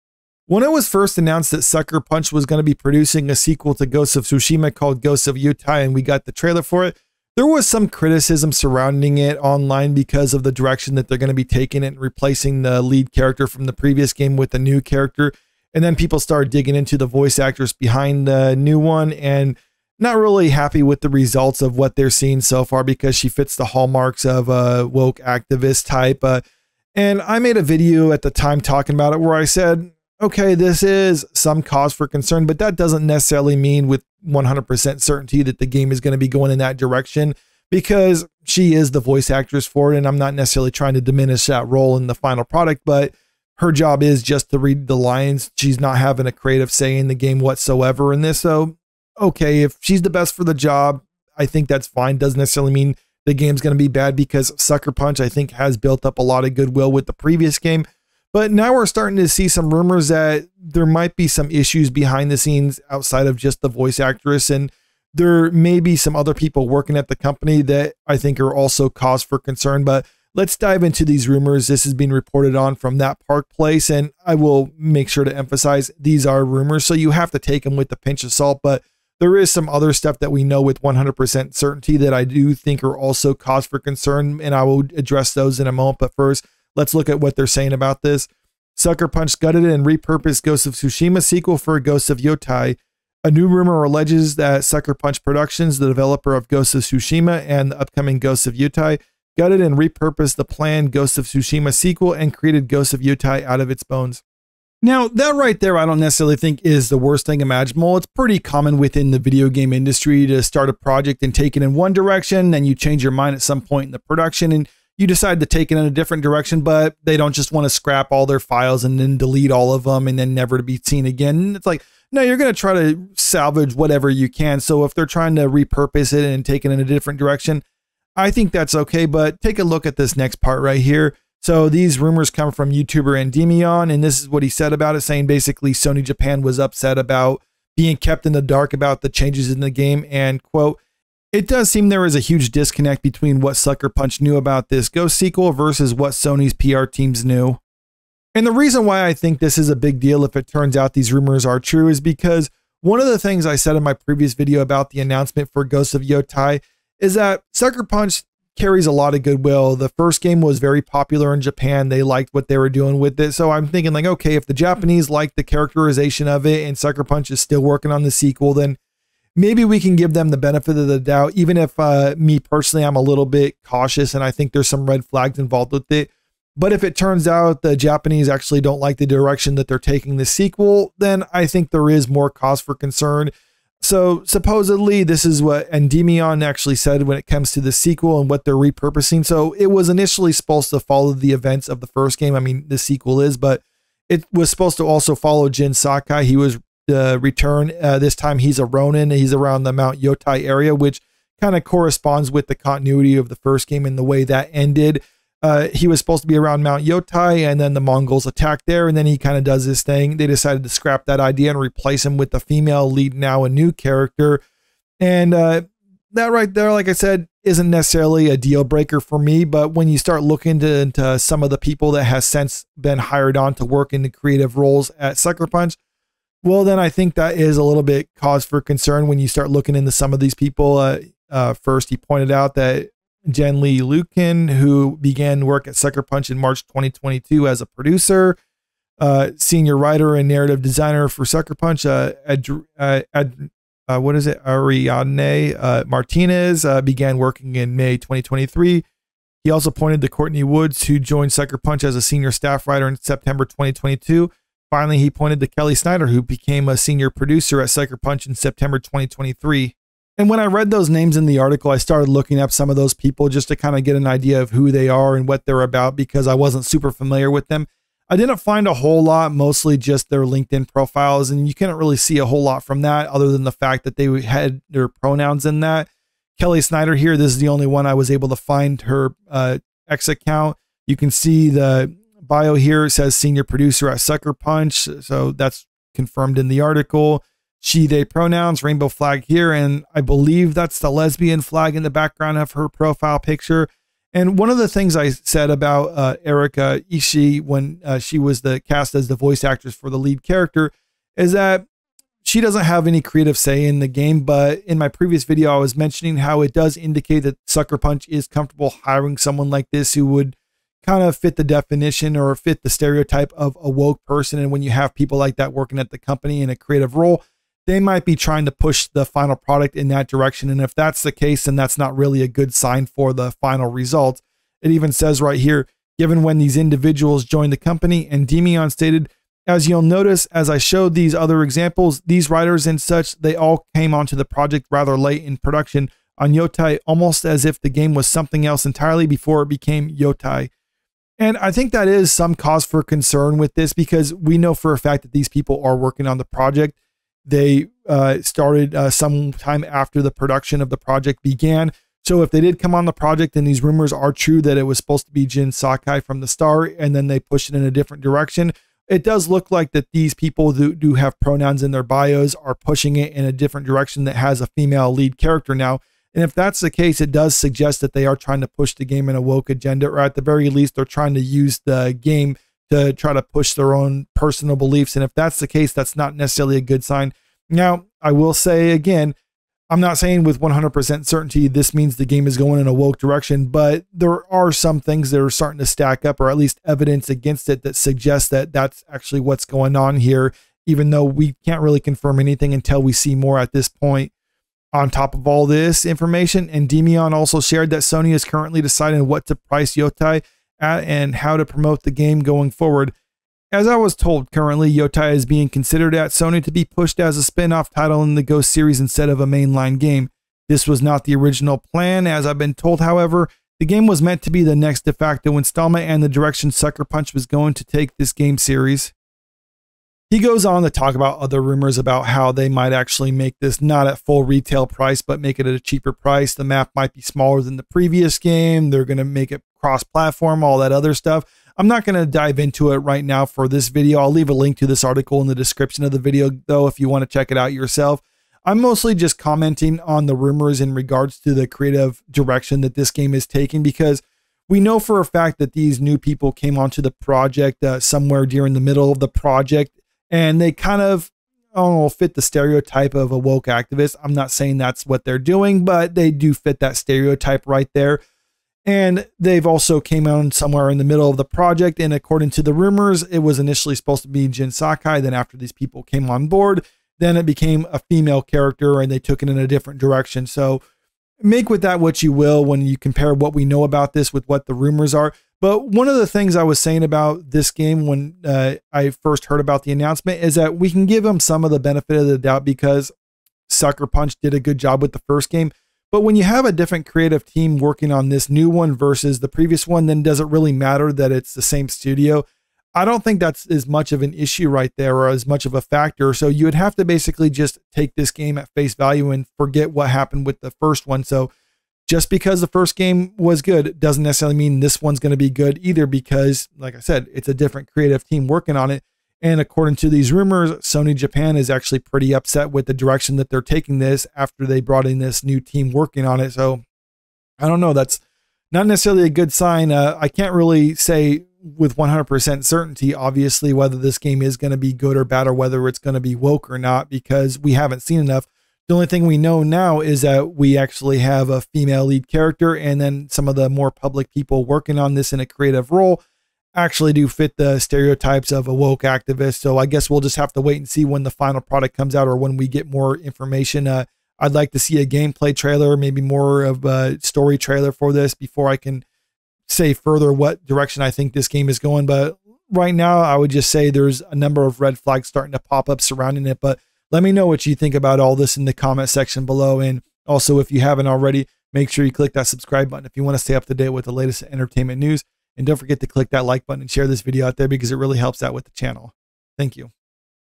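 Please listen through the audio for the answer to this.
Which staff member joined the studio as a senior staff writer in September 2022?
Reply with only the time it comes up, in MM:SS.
04:10.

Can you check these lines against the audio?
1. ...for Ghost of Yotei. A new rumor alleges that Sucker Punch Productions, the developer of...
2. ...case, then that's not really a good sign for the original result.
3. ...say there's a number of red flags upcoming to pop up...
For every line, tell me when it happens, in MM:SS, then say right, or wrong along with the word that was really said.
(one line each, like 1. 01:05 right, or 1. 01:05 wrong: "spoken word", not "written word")
1. 01:31 right
2. 05:21 wrong: "final", not "original"
3. 09:13 wrong: "starting", not "upcoming".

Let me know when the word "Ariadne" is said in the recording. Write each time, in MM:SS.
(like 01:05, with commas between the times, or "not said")
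04:04.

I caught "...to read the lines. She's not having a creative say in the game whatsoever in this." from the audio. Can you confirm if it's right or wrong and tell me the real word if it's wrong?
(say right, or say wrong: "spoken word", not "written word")
right.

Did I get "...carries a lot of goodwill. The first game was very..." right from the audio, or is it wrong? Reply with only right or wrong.
right.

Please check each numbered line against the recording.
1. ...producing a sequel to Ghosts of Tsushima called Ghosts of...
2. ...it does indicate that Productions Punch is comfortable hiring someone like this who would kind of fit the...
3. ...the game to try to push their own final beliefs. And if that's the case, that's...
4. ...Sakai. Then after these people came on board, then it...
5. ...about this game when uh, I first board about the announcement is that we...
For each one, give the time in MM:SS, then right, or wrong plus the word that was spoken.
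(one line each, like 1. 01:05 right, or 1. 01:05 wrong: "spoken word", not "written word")
1. 00:02 right
2. 05:06 wrong: "Sucker", not "Productions"
3. 06:11 wrong: "personal", not "final"
4. 07:44 right
5. 07:56 wrong: "heard", not "board".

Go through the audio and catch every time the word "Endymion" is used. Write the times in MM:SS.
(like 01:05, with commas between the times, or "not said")
02:13, 03:05, 05:28, 06:36.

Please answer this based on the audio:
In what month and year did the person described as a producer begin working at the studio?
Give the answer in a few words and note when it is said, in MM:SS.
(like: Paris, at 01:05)
March 2022, at 03:56.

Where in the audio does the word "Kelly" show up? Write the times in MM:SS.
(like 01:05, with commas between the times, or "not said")
04:15, 04:36.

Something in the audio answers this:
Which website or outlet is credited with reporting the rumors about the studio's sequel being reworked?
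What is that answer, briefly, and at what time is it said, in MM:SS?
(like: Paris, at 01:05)
That Park Place, at 01:12.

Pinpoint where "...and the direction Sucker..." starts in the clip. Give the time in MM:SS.
06:55.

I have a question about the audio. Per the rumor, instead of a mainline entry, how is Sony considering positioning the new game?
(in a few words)
spin off title.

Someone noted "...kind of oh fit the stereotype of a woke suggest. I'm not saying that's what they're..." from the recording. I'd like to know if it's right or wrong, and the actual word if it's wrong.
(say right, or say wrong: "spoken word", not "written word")
wrong: "activist", not "suggest".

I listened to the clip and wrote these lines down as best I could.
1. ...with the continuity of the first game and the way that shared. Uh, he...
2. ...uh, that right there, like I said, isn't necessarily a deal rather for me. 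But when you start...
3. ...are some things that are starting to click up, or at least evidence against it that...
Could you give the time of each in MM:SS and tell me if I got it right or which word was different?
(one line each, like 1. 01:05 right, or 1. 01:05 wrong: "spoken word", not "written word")
1. 03:22 wrong: "ended", not "shared"
2. 03:35 wrong: "breaker", not "rather"
3. 06:24 wrong: "stack", not "click".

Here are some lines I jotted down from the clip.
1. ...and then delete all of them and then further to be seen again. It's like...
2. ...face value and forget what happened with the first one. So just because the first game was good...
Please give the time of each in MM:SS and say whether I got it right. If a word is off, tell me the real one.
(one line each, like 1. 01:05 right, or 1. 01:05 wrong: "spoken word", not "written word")
1. 01:58 wrong: "never", not "further"
2. 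08:18 right.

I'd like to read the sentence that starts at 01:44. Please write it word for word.
Now, that right there, I don't necessarily think is the worst thing imaginable.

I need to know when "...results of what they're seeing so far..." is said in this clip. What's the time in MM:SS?
00:21.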